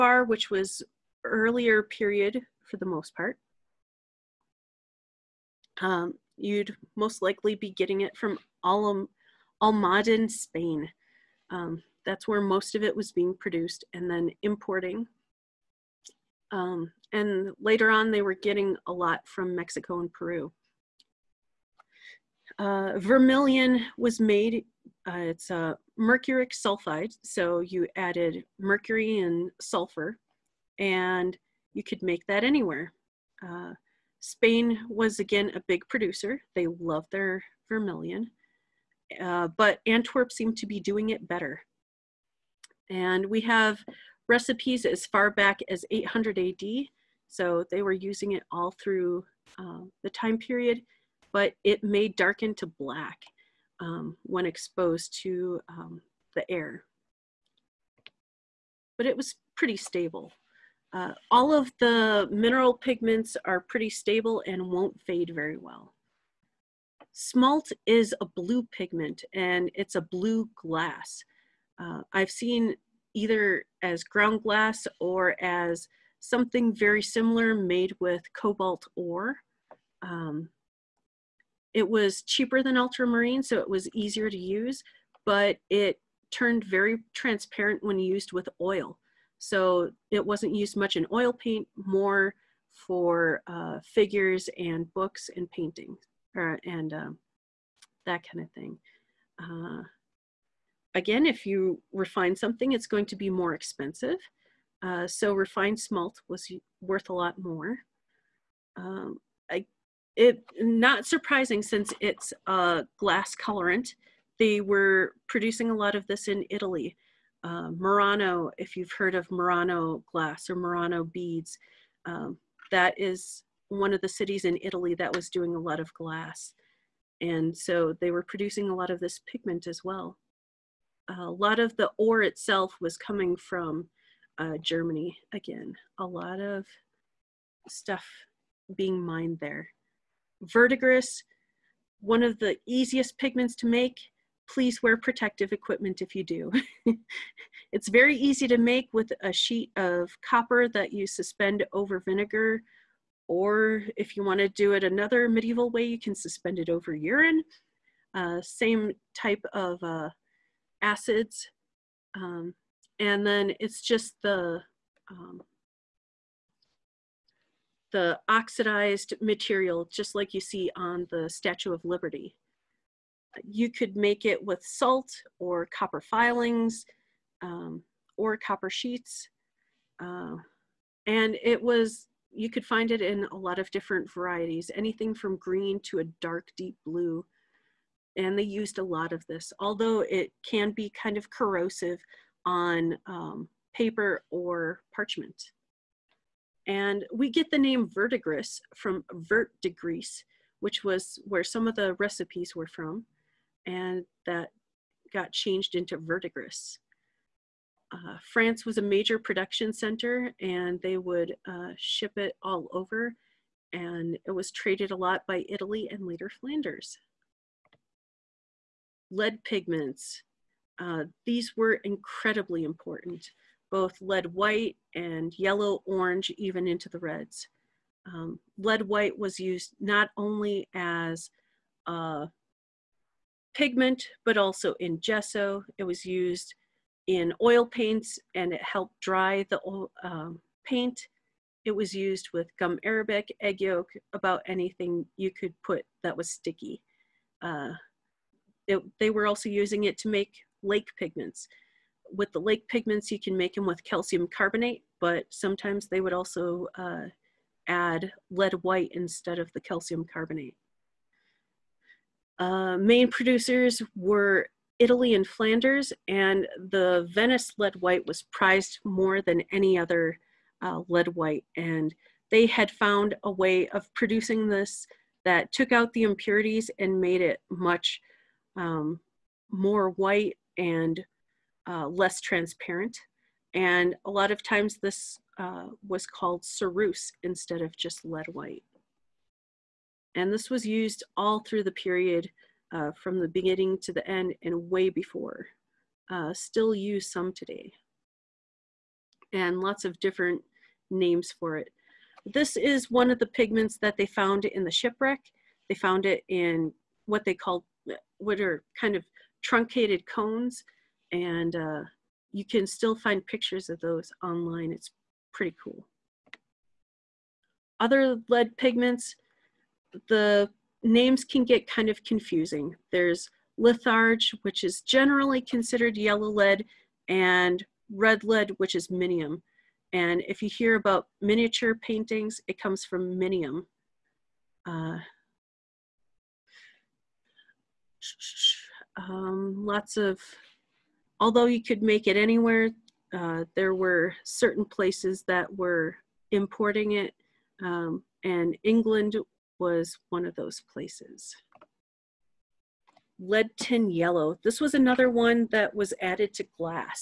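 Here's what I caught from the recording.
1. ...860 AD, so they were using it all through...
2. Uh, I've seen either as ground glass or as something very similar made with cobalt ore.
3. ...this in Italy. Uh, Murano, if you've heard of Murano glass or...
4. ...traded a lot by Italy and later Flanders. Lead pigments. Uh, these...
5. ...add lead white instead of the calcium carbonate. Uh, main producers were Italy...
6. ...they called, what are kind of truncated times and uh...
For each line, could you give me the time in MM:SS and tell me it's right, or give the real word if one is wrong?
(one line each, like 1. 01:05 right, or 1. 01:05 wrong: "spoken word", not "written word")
1. 00:45 wrong: "800", not "860"
2. 01:11 right
3. 01:56 right
4. 03:34 right
5. 04:17 right
6. 05:07 wrong: "cones", not "times".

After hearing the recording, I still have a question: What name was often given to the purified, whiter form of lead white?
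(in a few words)
ceruse.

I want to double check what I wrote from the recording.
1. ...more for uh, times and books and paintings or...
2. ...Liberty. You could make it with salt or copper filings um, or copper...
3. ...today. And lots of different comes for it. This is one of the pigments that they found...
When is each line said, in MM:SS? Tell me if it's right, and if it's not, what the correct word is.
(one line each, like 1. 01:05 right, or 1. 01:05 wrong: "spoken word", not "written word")
1. 01:31 wrong: "figures", not "times"
2. 02:51 right
3. 04:57 wrong: "names", not "comes".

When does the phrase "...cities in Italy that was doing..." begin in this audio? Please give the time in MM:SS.
02:04.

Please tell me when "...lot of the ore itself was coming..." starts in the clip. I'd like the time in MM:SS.
02:11.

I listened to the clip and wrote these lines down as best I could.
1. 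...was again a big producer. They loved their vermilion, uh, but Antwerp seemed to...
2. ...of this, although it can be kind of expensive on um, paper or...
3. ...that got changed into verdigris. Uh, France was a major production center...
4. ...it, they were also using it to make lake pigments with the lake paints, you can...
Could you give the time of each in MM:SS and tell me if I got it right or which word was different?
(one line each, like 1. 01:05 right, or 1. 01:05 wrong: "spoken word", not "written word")
1. 00:34 right
2. 03:09 wrong: "corrosive", not "expensive"
3. 03:24 right
4. 04:08 wrong: "pigments", not "paints".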